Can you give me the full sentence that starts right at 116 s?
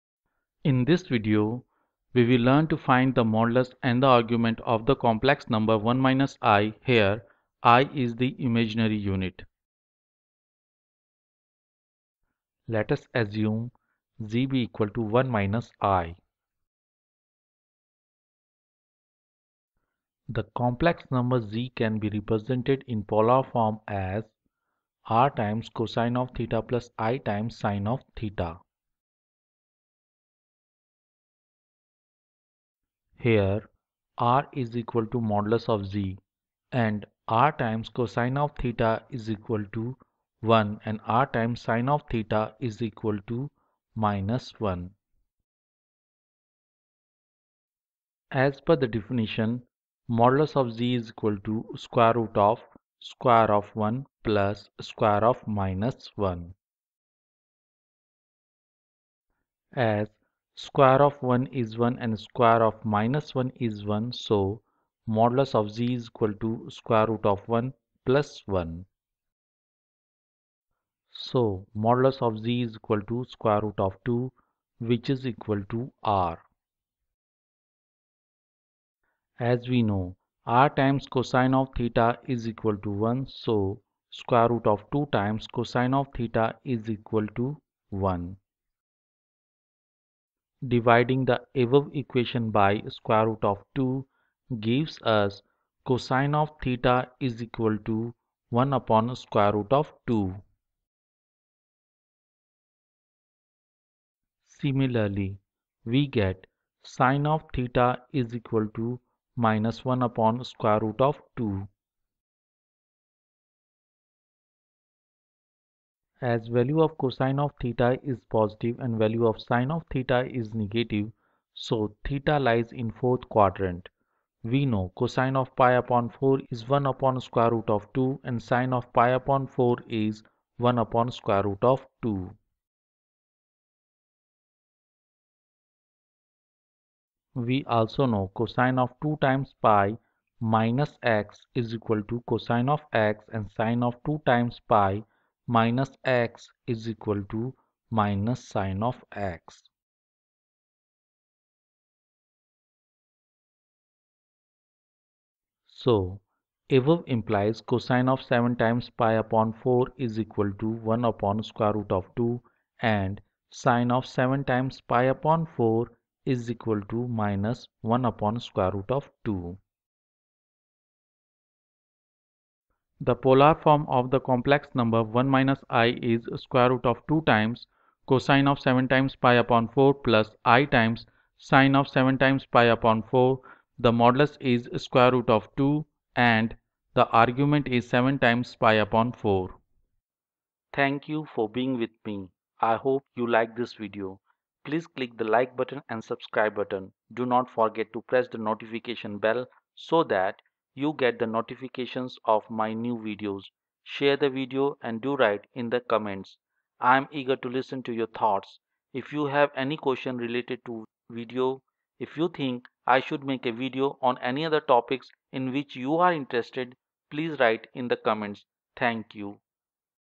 As value of cosine of theta is positive and value of sine of theta is negative, so theta lies in fourth quadrant.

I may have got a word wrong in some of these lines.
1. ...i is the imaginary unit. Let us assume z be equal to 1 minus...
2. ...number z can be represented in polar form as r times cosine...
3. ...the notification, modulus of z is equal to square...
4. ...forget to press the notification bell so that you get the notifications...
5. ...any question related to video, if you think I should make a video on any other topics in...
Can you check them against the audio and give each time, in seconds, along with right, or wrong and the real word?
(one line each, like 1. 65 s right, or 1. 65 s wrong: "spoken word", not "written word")
1. 7 s right
2. 21 s right
3. 48 s wrong: "definition", not "notification"
4. 197 s right
5. 209 s right.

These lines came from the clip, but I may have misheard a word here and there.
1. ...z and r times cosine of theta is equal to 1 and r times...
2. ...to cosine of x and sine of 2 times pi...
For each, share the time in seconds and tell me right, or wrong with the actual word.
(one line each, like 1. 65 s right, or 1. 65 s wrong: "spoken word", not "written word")
1. 35 s right
2. 142 s right.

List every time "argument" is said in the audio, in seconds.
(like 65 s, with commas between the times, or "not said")
4 s, 187 s.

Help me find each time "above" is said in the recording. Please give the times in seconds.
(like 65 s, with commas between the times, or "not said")
91 s, 156 s.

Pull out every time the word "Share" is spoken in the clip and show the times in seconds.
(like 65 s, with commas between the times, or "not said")
203 s.